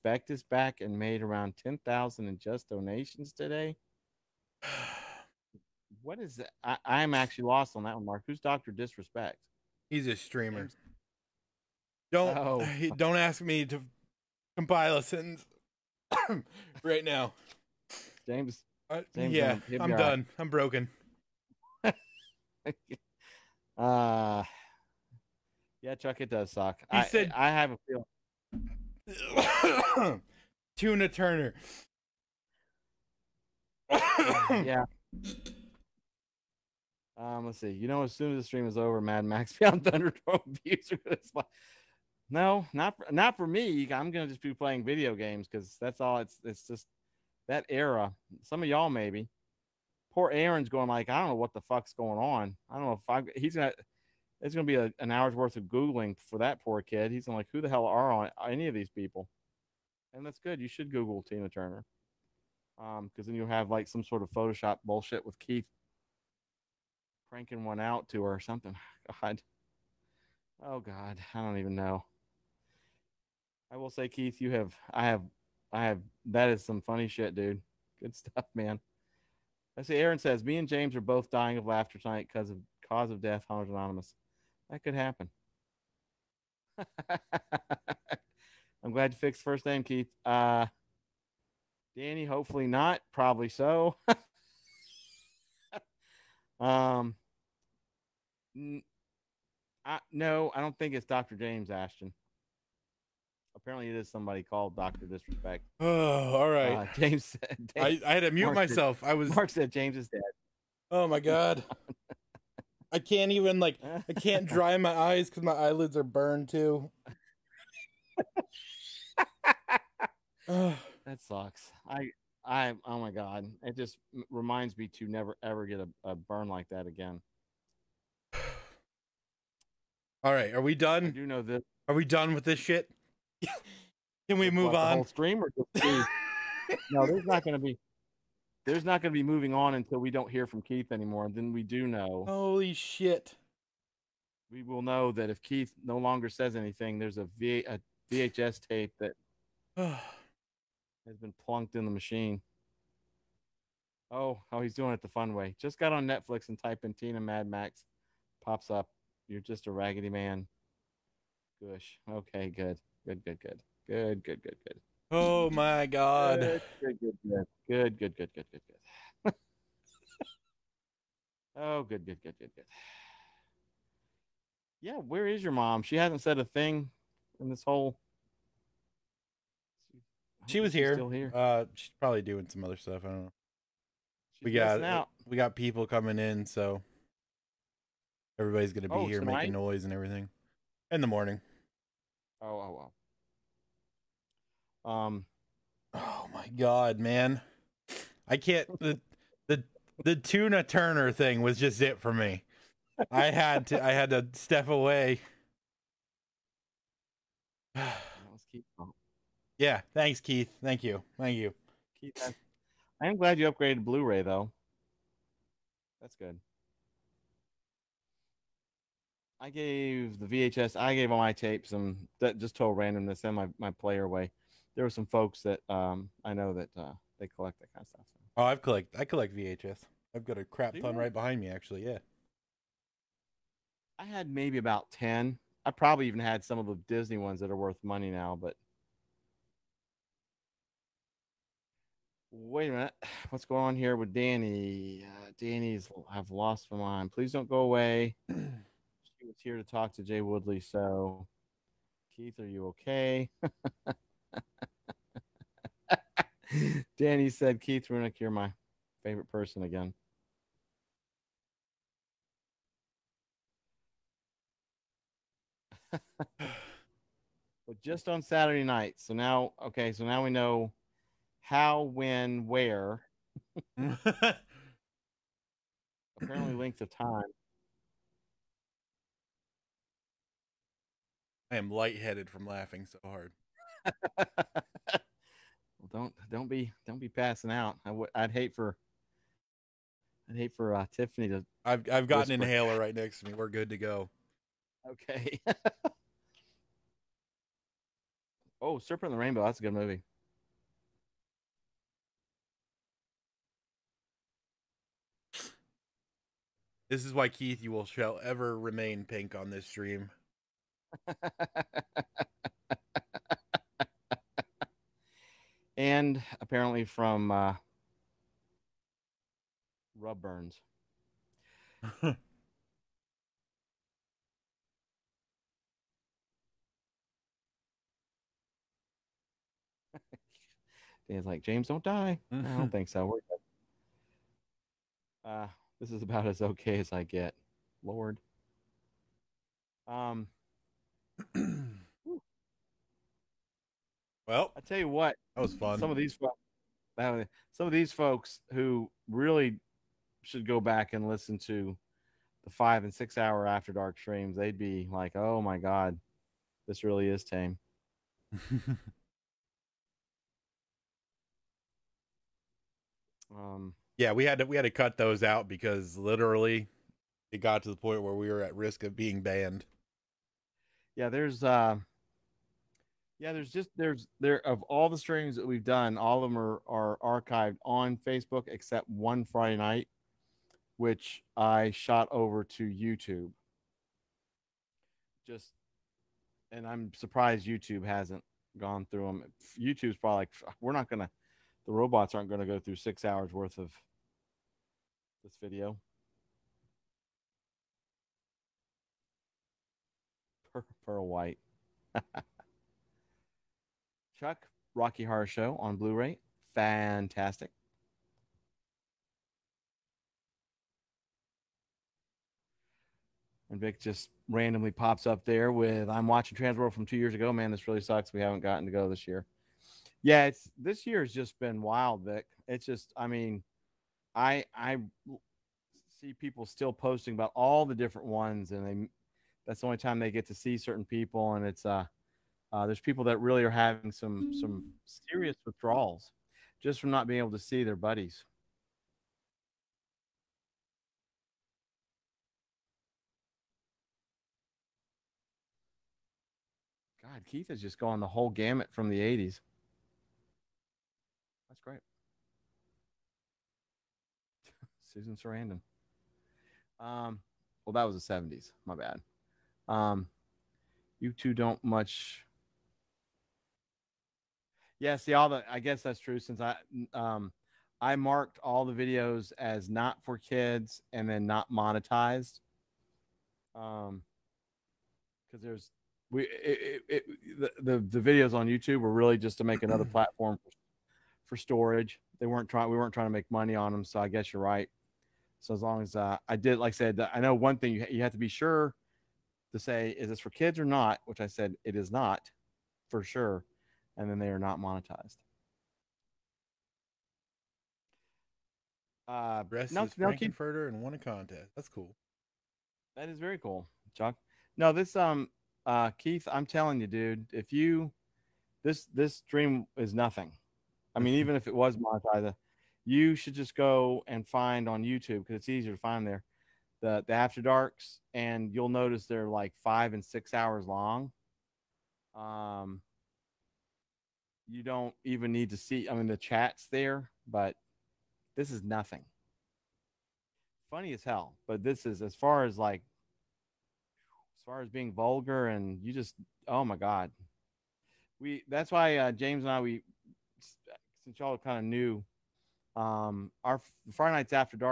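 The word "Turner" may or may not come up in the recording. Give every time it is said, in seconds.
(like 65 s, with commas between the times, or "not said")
31 s, 61 s, 200 s.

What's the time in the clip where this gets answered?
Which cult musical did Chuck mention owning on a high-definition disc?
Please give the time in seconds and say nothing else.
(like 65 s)
404 s.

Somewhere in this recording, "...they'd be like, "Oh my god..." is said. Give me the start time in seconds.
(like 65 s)
354 s.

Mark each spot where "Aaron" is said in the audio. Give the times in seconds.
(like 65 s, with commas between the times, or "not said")
50 s, 79 s.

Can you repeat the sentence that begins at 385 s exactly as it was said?
Just and I'm surprised YouTube hasn't gone through them.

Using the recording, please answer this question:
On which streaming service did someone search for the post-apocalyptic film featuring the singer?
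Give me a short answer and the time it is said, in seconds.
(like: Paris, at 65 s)
Netflix, at 156 s.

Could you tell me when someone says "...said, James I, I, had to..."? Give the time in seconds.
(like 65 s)
107 s.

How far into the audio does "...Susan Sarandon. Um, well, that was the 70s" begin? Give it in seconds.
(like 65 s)
454 s.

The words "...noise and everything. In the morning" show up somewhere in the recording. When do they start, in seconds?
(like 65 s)
189 s.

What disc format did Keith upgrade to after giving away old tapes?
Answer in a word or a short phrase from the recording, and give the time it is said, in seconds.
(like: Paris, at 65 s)
Blu-ray, at 213 s.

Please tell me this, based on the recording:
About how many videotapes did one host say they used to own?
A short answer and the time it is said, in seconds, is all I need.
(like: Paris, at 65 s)
10, at 234 s.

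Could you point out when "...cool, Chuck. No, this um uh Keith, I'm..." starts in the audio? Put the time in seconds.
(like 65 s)
503 s.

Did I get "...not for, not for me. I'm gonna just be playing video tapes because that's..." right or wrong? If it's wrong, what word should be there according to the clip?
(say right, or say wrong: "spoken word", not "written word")
wrong: "games", not "tapes".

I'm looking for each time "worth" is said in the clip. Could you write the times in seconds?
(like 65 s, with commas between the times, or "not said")
55 s, 237 s, 393 s.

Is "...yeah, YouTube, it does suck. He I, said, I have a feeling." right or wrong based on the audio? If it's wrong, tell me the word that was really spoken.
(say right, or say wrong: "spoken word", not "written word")
wrong: "Chuck", not "YouTube".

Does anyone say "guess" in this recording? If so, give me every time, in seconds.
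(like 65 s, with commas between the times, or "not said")
465 s, 484 s.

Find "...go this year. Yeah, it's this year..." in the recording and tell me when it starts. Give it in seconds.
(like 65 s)
418 s.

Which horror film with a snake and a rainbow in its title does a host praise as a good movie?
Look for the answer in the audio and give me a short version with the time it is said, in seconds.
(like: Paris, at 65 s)
Serpent in the Rainbow, at 298 s.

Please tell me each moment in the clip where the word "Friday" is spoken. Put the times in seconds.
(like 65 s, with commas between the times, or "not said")
379 s, 543 s.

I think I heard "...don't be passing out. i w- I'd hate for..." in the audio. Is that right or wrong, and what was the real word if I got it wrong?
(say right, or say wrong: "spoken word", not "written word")
right.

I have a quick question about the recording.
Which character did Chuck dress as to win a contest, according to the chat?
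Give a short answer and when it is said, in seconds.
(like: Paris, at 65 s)
Frank-N-Furter, at 500 s.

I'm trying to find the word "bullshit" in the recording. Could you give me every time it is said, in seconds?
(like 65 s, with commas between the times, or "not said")
64 s.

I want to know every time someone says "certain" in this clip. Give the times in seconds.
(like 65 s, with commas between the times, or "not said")
430 s.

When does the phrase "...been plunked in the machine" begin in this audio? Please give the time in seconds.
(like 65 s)
151 s.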